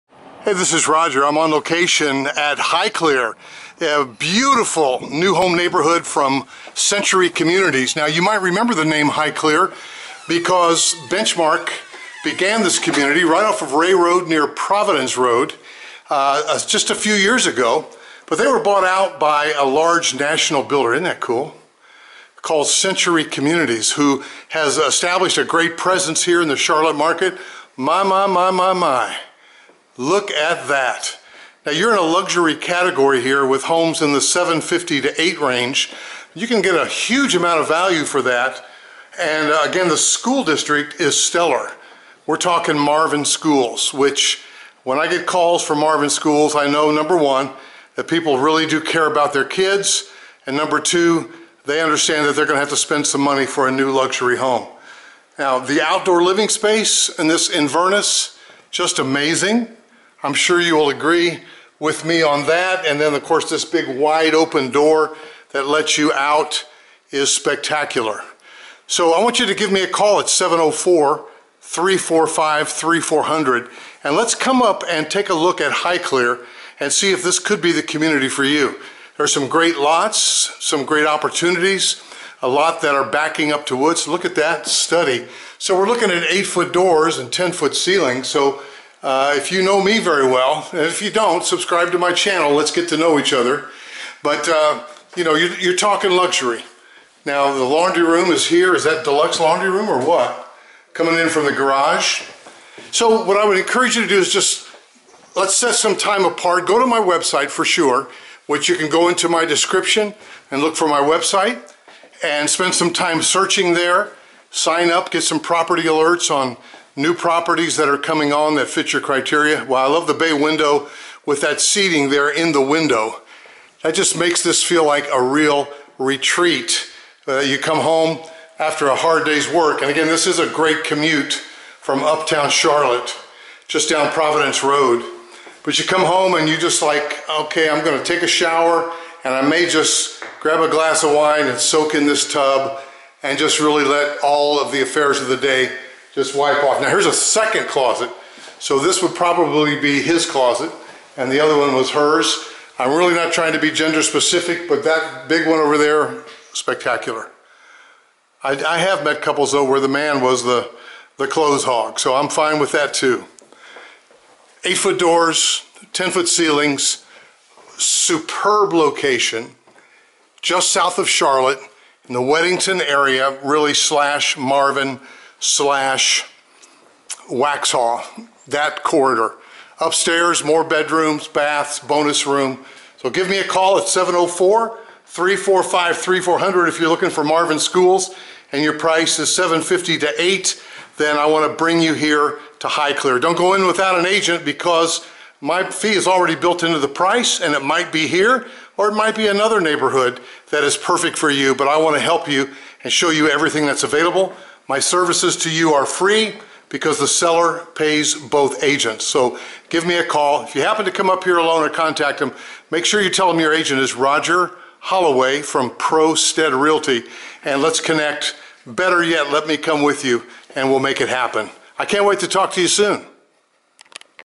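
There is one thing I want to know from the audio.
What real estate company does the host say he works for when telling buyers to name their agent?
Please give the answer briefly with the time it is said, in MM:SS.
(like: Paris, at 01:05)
ProStead Realty, at 03:35.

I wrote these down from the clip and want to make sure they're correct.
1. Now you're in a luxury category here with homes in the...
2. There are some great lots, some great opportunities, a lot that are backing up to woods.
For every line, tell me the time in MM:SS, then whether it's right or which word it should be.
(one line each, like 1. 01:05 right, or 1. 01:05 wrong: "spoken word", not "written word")
1. 00:31 right
2. 01:19 right.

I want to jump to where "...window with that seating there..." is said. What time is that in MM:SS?
02:00.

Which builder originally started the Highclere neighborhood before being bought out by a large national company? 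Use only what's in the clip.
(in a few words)
Benchmark.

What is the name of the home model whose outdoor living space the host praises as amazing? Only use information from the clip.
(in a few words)
Inverness.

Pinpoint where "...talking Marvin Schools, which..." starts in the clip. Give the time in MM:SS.
00:42.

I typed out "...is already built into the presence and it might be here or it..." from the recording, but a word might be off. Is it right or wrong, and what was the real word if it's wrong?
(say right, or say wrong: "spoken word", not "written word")
wrong: "price", not "presence".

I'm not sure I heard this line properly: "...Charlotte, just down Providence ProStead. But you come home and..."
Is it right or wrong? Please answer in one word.
wrong.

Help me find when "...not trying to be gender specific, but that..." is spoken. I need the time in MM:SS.
02:33.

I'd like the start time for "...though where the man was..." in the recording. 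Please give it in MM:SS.
02:39.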